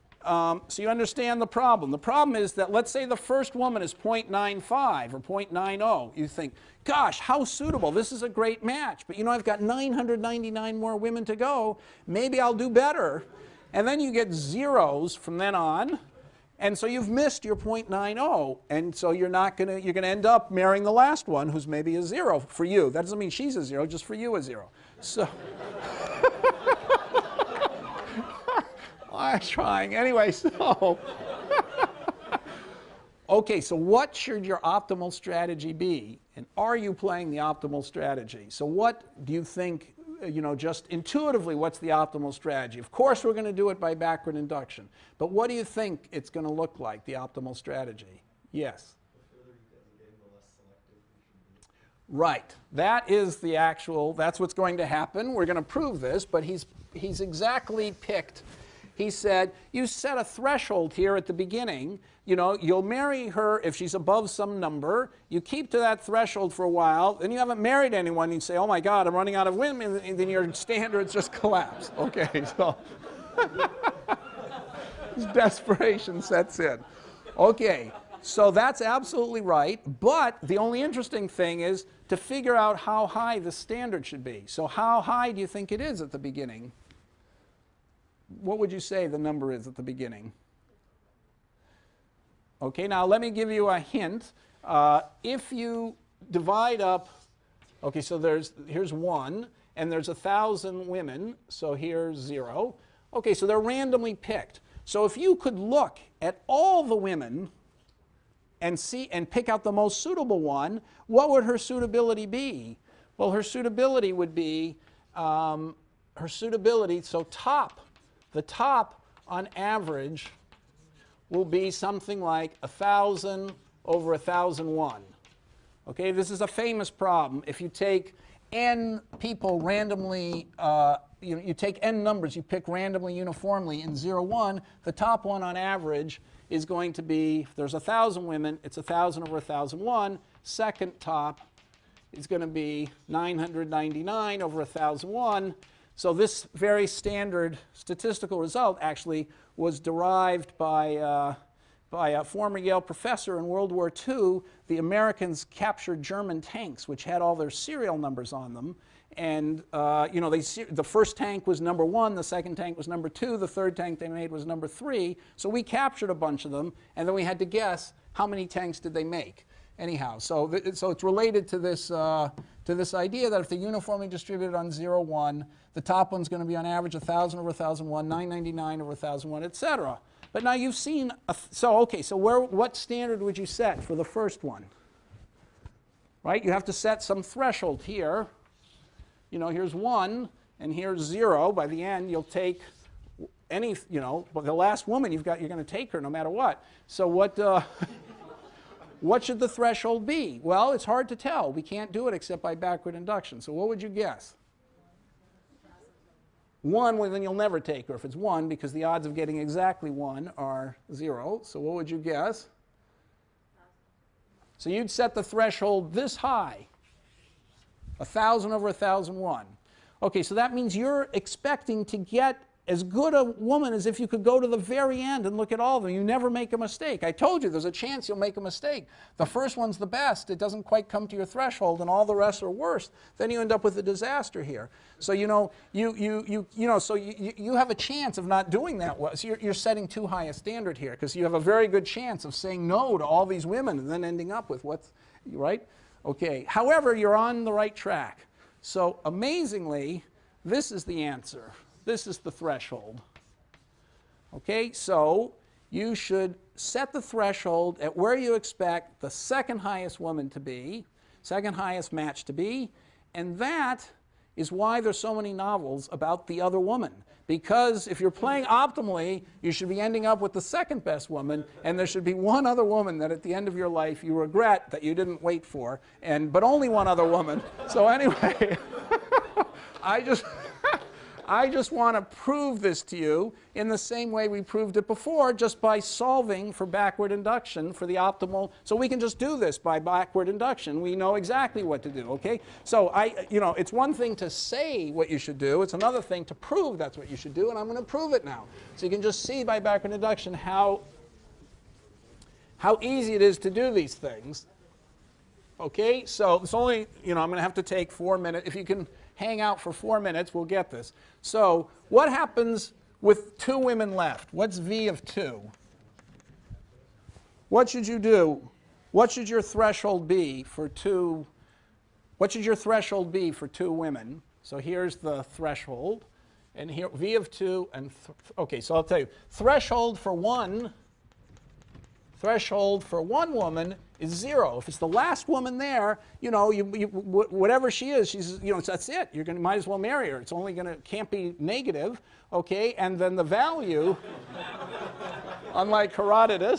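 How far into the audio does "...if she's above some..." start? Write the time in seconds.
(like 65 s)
63 s.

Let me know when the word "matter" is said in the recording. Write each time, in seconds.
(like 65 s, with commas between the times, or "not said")
196 s.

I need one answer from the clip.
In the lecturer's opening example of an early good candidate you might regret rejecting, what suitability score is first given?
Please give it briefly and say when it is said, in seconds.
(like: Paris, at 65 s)
0.95, at 3 s.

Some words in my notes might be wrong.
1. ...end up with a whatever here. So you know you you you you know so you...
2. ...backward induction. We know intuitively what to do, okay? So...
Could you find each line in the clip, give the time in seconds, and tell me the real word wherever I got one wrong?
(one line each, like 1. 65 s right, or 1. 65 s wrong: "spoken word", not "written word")
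1. 233 s wrong: "disaster", not "whatever"
2. 289 s wrong: "exactly", not "intuitively".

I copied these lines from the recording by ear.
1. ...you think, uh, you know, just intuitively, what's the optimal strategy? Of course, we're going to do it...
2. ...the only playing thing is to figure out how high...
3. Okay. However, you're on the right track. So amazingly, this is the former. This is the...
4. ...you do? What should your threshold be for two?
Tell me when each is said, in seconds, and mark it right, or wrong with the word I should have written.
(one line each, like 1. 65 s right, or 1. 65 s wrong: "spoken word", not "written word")
1. 39 s right
2. 80 s wrong: "interesting", not "playing"
3. 246 s wrong: "answer", not "former"
4. 317 s right.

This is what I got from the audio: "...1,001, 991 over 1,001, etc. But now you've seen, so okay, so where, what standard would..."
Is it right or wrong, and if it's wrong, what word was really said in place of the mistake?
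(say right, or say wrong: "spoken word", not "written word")
wrong: "999", not "991".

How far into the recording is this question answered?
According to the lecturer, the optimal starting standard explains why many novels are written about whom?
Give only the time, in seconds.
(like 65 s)
266 s.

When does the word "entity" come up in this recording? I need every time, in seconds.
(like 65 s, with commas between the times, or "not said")
not said.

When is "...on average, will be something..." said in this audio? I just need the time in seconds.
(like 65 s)
119 s.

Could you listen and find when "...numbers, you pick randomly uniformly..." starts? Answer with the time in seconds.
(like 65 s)
132 s.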